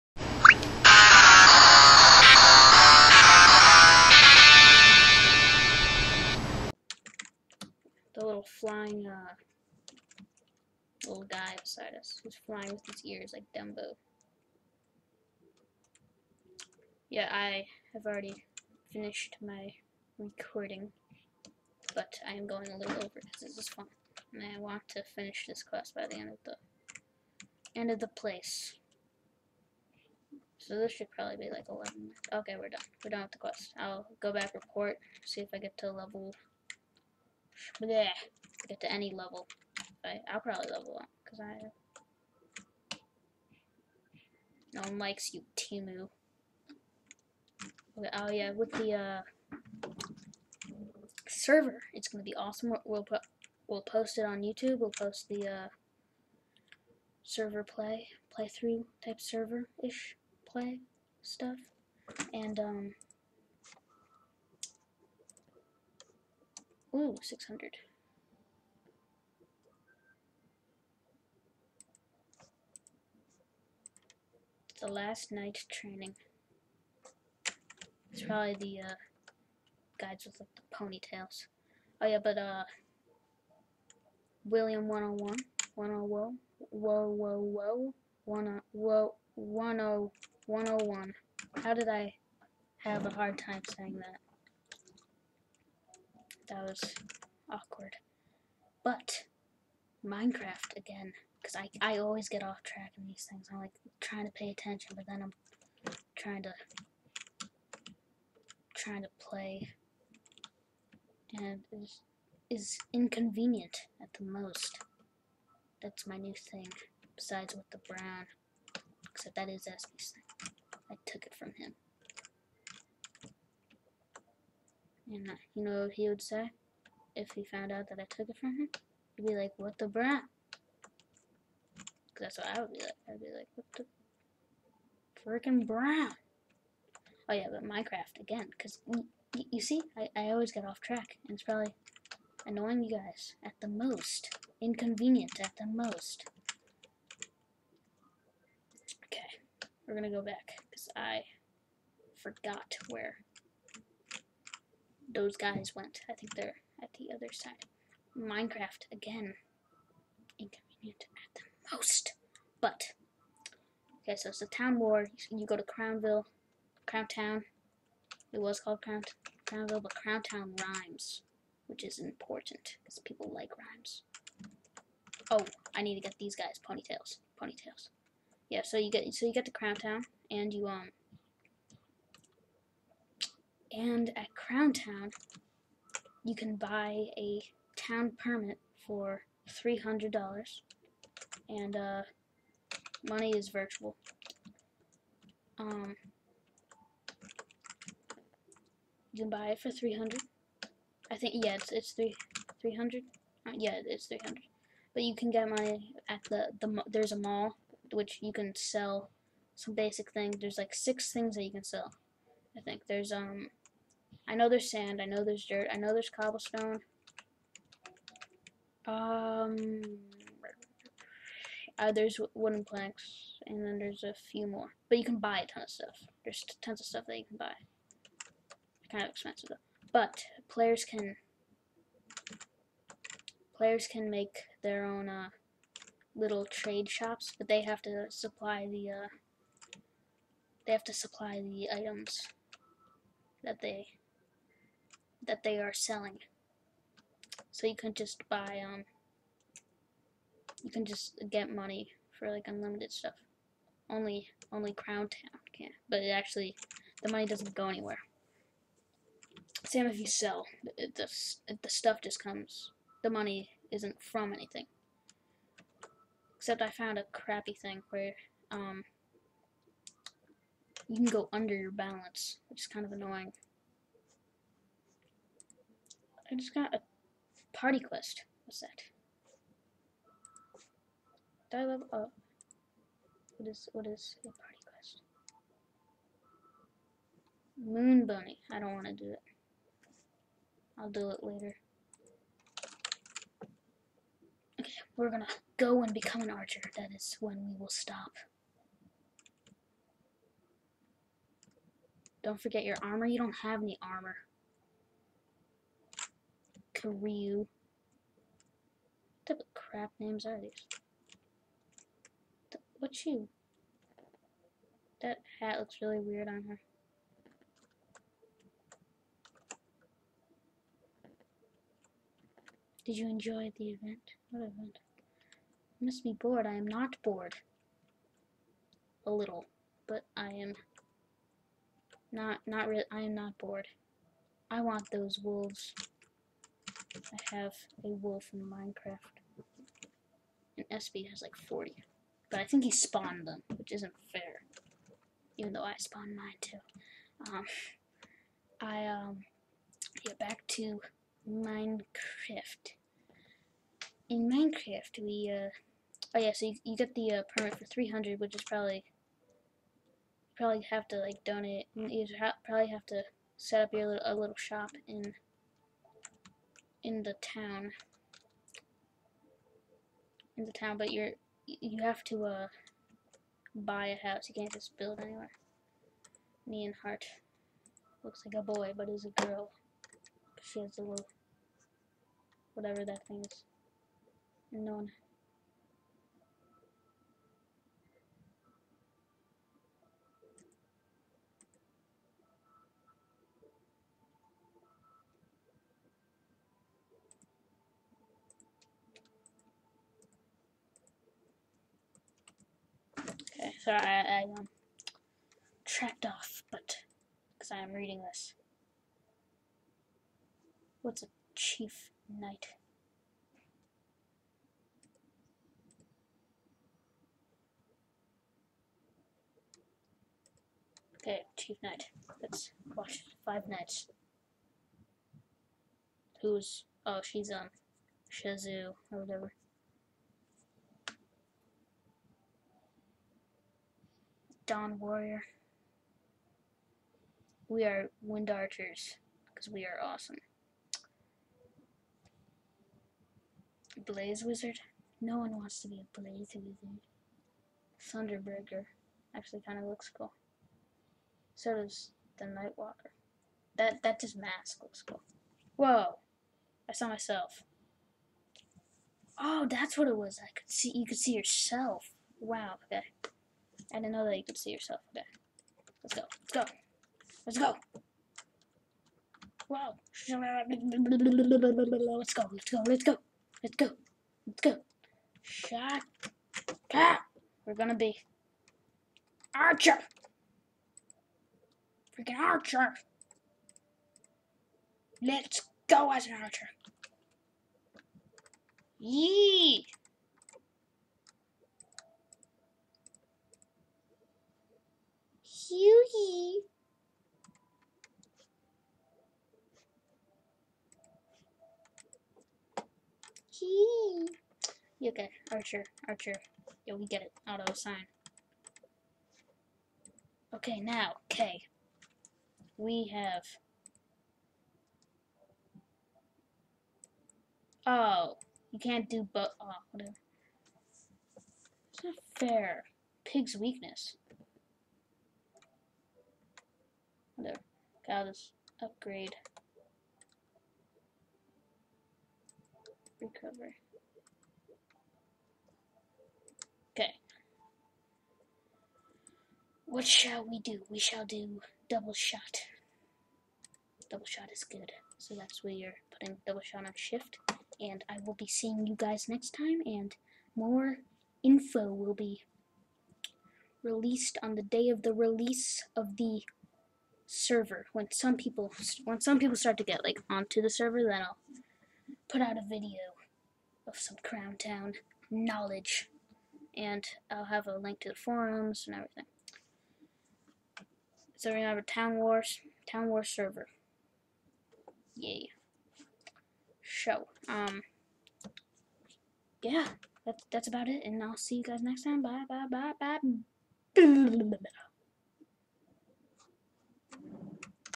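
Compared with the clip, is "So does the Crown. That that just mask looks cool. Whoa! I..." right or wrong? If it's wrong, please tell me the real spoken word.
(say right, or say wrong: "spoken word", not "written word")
wrong: "Nightwalker", not "Crown".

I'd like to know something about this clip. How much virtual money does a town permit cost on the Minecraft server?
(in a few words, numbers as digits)
300.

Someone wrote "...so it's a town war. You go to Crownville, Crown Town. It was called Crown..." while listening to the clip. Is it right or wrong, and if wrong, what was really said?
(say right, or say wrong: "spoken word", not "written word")
right.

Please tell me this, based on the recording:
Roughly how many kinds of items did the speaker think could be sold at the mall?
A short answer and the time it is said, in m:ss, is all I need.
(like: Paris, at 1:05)
6, at 3:30.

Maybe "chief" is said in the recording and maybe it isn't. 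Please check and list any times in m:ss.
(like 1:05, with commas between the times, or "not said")
6:51, 7:01.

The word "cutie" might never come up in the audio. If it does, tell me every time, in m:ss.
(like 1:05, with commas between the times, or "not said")
8:15, 8:23.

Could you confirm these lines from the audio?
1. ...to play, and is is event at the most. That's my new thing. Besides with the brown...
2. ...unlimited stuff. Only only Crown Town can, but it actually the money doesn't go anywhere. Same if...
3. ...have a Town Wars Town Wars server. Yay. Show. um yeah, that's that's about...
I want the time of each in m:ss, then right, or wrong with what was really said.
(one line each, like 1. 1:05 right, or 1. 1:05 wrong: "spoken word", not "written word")
1. 1:49 wrong: "inconvenient", not "event"
2. 4:12 right
3. 9:31 right.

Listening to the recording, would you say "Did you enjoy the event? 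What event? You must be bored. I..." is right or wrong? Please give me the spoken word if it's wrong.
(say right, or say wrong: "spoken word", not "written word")
right.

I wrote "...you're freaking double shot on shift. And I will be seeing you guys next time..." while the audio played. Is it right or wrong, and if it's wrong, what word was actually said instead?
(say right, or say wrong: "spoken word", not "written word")
wrong: "putting", not "freaking".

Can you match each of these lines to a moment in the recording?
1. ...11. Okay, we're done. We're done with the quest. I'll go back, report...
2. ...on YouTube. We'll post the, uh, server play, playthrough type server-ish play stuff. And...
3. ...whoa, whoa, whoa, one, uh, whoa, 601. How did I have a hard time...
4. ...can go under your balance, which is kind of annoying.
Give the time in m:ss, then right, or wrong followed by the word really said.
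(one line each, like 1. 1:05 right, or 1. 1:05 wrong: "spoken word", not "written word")
1. 0:31 right
2. 0:54 right
3. 1:26 wrong: "101", not "601"
4. 4:30 right.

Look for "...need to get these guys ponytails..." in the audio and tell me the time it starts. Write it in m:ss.
2:55.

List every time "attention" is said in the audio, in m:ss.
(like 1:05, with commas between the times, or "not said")
1:44.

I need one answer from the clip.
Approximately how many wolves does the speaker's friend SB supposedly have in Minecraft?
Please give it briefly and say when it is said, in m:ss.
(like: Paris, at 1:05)
40, at 5:41.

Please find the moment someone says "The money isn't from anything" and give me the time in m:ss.
4:23.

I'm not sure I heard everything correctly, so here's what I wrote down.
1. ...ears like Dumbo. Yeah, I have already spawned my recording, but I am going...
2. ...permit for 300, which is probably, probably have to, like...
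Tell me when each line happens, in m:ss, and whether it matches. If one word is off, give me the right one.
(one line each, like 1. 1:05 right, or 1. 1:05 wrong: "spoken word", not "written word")
1. 0:13 wrong: "finished", not "spawned"
2. 5:57 right.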